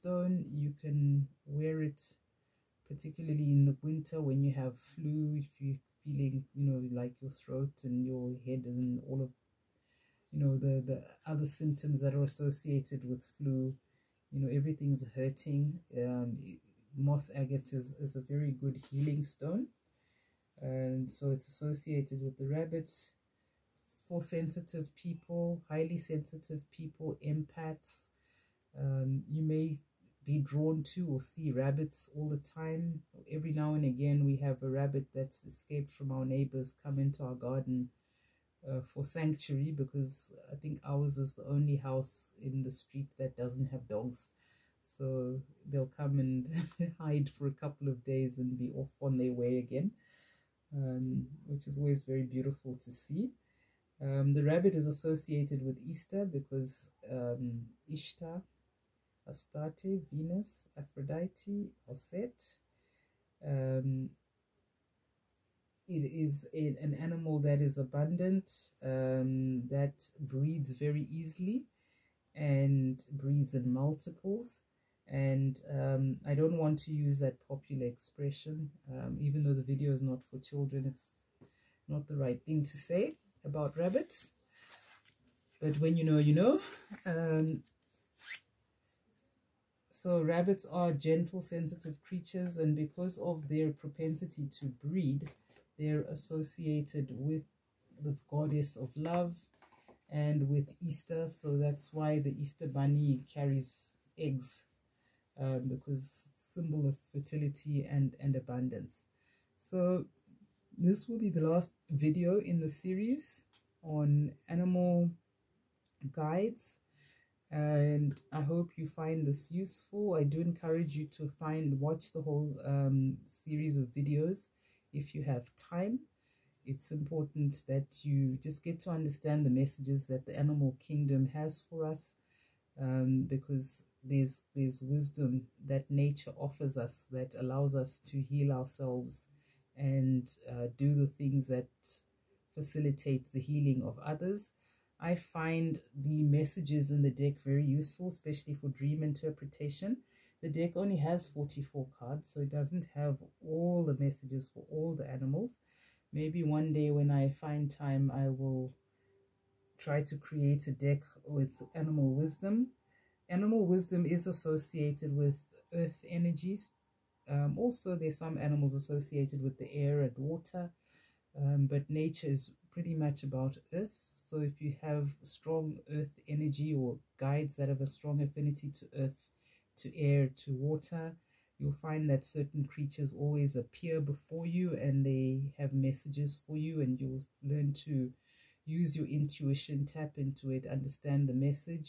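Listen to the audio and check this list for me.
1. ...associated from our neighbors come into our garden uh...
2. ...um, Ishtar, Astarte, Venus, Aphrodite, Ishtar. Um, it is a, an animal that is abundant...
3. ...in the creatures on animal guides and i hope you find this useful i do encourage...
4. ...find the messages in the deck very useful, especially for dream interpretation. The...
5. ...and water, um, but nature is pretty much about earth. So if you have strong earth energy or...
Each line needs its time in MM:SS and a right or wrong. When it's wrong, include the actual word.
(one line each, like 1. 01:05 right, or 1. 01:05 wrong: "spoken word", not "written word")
1. 00:35 wrong: "escaped", not "associated"
2. 00:57 wrong: "Osset", not "Ishtar"
3. 01:52 wrong: "series", not "creatures"
4. 02:25 right
5. 02:50 right.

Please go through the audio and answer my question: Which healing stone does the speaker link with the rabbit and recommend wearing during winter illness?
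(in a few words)
Moss agate.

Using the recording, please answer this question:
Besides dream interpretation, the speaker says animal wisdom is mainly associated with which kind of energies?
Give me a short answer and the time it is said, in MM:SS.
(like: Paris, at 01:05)
Earth energies, at 02:45.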